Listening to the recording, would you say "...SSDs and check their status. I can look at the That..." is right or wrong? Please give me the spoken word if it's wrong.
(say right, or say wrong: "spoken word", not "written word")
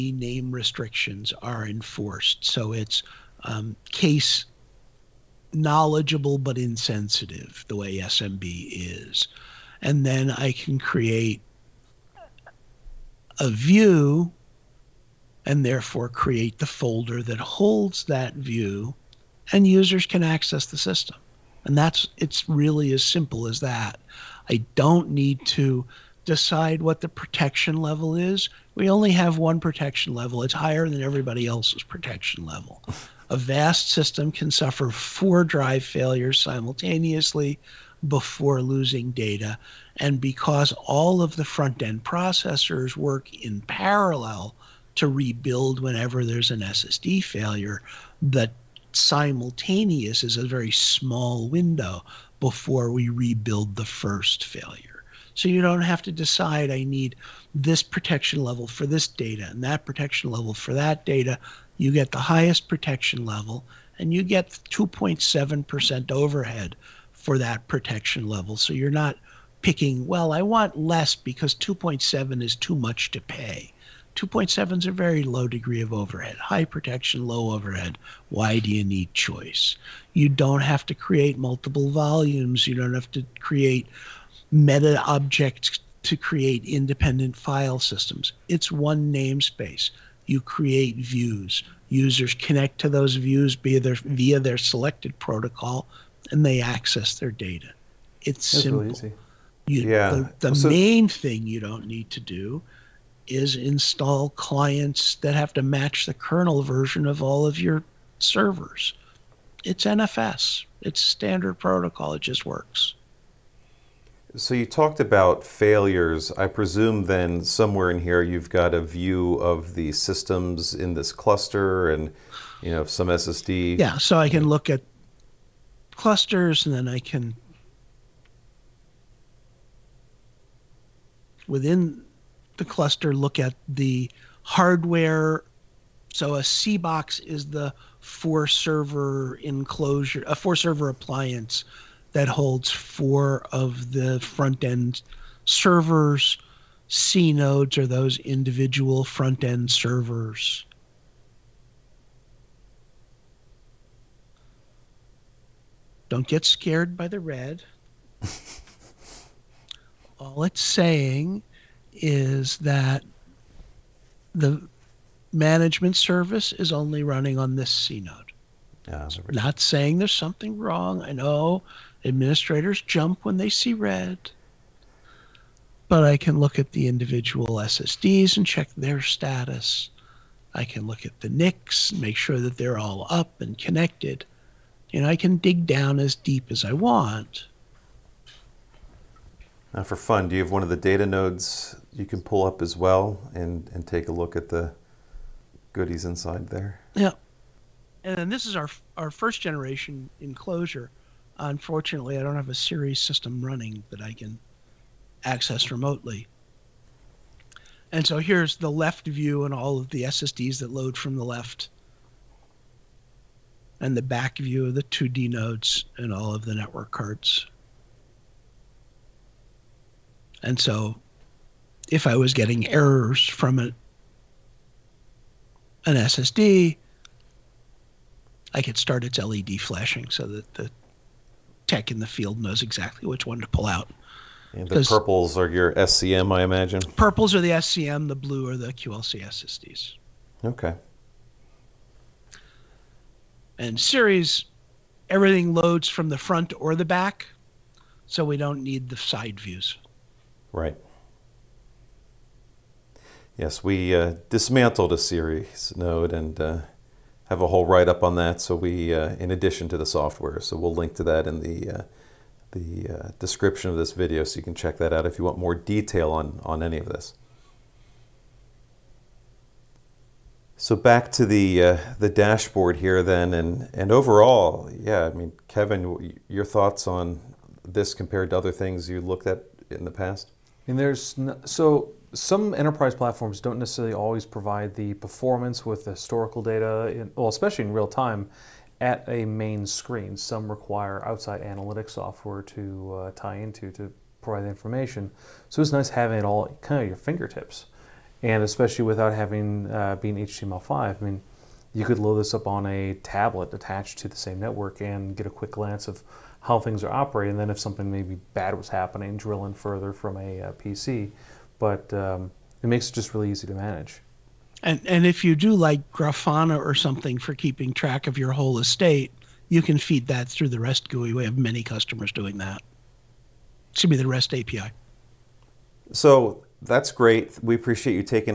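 wrong: "NICs", not "That".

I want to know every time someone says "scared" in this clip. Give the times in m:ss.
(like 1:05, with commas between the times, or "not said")
2:36.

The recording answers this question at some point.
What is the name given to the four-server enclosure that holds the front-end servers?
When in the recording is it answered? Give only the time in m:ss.
2:16.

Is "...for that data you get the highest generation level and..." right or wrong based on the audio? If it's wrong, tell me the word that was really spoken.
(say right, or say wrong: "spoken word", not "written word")
wrong: "protection", not "generation".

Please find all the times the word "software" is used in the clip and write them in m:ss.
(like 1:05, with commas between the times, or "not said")
4:19, 4:51.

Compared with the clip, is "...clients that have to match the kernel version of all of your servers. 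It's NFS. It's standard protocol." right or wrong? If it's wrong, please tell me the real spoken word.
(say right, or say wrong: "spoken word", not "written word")
right.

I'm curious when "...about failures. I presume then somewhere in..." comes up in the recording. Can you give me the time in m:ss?
1:54.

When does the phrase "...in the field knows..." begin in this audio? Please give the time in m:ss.
3:51.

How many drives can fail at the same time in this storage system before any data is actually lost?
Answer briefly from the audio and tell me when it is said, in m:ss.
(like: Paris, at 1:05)
4, at 0:34.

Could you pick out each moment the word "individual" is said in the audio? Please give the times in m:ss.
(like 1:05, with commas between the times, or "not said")
2:28, 2:56.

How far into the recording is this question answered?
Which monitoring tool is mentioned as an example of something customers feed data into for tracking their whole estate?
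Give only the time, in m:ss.
5:15.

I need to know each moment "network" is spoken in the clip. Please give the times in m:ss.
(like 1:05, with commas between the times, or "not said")
3:36, 5:04.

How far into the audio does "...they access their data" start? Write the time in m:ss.
1:36.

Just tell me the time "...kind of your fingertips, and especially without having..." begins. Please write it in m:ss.
4:56.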